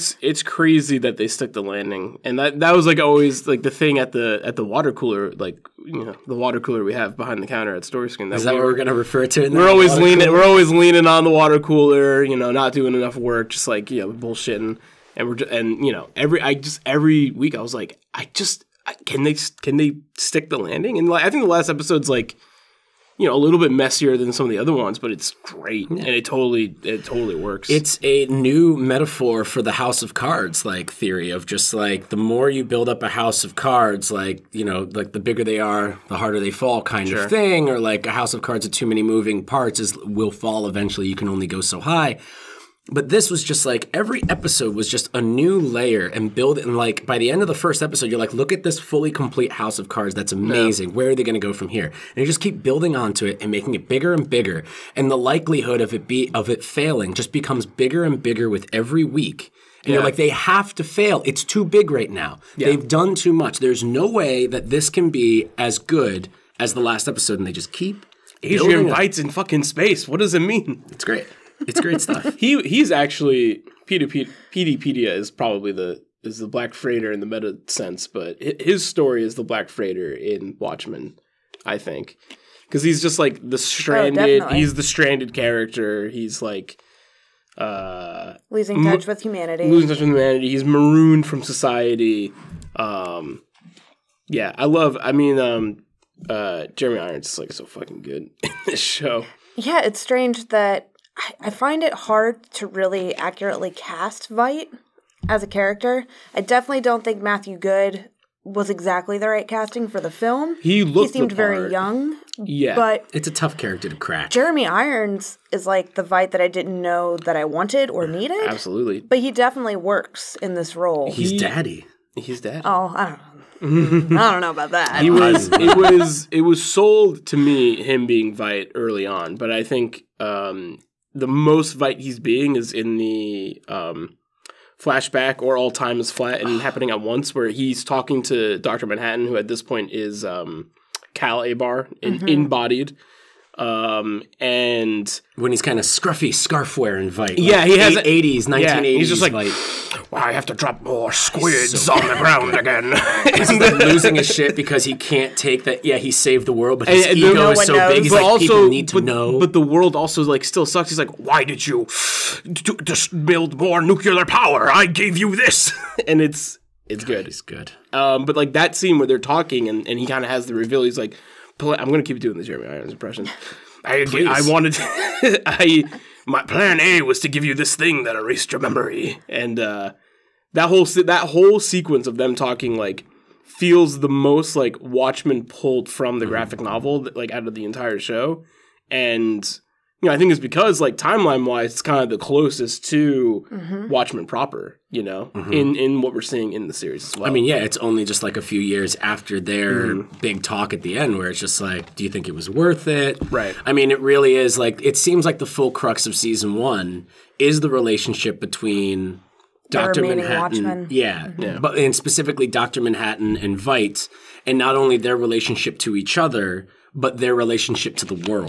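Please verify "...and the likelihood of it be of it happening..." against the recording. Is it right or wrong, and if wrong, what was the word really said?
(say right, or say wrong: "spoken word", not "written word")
wrong: "failing", not "happening".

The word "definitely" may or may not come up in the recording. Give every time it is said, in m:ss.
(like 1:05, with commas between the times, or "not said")
1:46, 1:59.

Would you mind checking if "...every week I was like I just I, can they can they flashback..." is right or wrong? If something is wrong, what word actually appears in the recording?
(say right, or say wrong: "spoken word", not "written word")
wrong: "stick", not "flashback".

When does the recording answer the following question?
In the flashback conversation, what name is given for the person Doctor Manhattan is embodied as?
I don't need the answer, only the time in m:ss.
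2:21.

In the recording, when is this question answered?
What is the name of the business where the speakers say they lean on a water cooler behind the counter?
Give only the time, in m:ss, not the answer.
0:07.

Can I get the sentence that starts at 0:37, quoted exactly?
of thing, or like a house of cards with too many moving parts is will fall eventually.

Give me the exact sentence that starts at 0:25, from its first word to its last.
and it totally it totally works.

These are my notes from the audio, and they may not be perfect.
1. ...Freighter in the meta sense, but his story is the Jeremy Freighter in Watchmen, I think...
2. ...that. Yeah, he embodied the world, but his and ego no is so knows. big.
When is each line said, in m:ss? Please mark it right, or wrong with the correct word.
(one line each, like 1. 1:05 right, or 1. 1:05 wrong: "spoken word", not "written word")
1. 1:16 wrong: "Black", not "Jeremy"
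2. 2:35 wrong: "saved", not "embodied".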